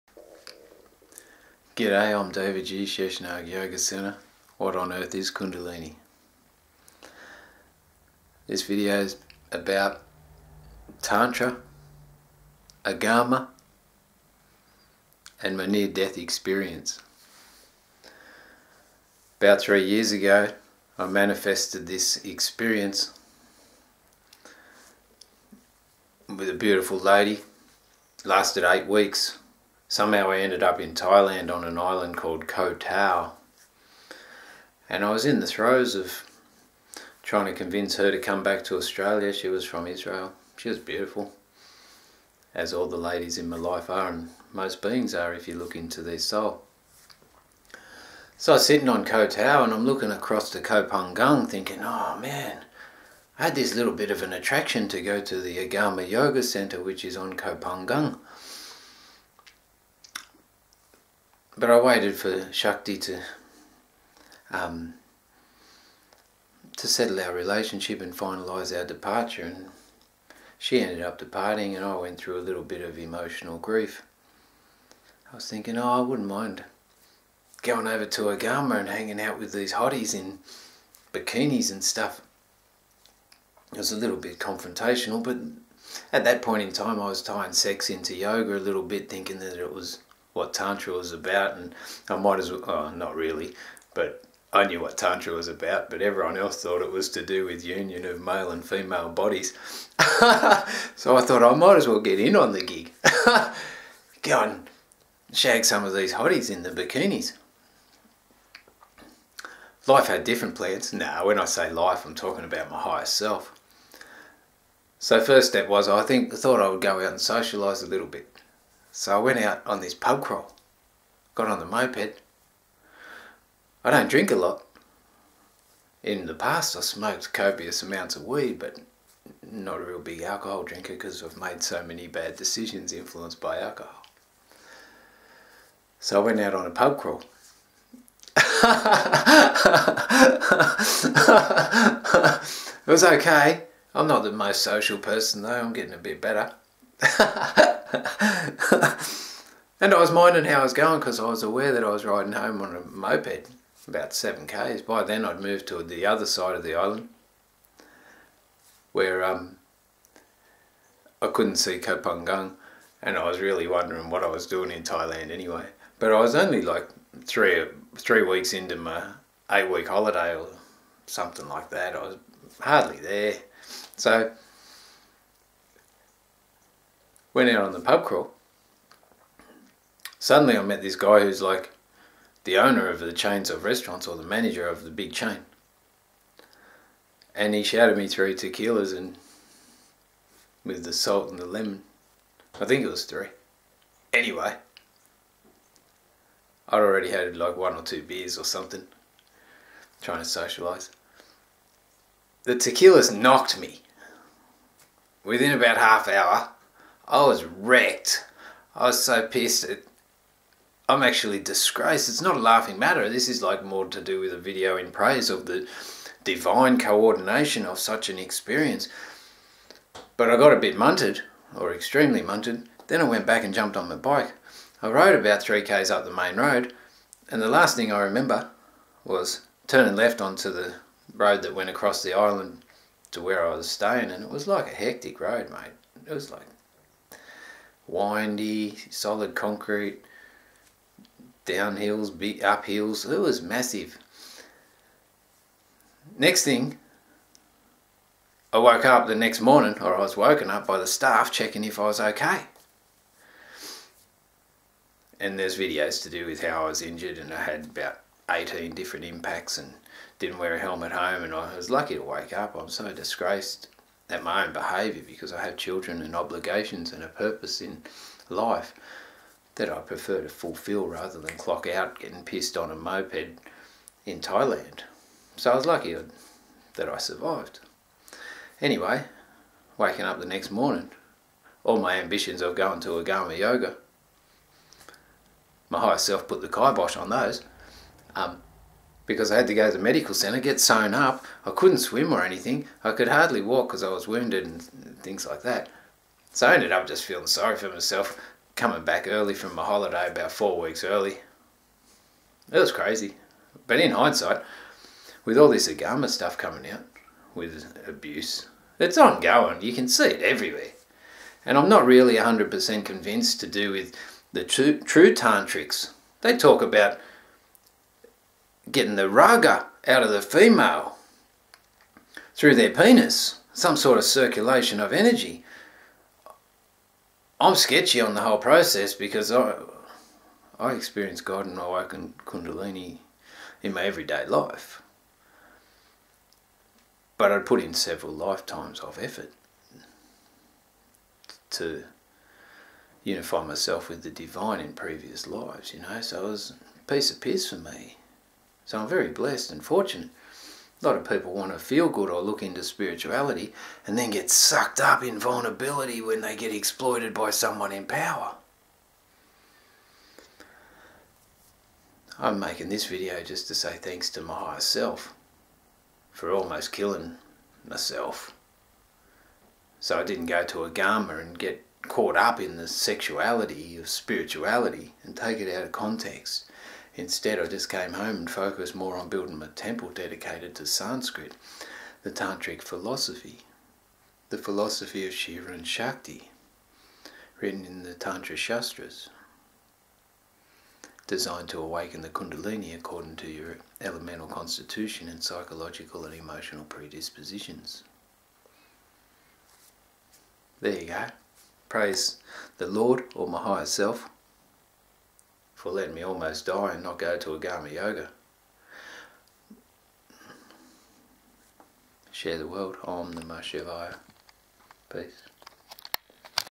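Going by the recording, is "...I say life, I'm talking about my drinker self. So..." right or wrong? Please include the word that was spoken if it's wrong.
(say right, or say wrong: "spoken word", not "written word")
wrong: "higher", not "drinker".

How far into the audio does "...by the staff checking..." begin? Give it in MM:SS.
04:10.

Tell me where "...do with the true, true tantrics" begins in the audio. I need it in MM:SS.
05:13.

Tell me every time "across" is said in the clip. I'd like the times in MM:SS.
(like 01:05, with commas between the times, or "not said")
00:50, 03:51.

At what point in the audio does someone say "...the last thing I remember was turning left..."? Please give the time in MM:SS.
03:47.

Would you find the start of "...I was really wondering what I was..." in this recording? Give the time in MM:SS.
02:43.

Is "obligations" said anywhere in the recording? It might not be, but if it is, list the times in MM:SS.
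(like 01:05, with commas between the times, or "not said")
04:26.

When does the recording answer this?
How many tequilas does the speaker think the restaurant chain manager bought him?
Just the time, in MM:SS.
03:08.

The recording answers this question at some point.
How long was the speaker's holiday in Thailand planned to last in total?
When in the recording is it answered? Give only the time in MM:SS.
02:49.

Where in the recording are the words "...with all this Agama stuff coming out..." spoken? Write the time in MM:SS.
05:05.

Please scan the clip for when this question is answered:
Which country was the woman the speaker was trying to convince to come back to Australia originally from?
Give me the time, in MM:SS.
00:39.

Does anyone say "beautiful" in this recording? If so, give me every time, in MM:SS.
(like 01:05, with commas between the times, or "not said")
00:26, 00:40.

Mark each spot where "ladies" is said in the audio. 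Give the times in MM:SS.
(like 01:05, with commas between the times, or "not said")
00:43.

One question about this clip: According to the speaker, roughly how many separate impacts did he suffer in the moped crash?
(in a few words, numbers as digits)
18.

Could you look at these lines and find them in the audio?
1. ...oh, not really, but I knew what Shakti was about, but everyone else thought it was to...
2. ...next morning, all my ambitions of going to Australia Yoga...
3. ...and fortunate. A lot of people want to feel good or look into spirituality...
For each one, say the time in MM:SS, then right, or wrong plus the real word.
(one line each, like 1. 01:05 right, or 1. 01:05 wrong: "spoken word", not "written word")
1. 01:32 wrong: "Tantra", not "Shakti"
2. 04:40 wrong: "Agama", not "Australia"
3. 05:49 right.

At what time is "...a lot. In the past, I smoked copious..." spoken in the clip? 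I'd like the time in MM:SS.
02:04.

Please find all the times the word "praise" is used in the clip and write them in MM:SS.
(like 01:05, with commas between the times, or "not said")
03:34, 06:41.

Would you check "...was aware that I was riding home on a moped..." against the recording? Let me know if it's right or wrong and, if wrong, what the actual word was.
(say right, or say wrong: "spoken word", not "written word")
right.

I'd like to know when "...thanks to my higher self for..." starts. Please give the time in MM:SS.
06:03.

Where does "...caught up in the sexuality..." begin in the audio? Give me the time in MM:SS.
06:11.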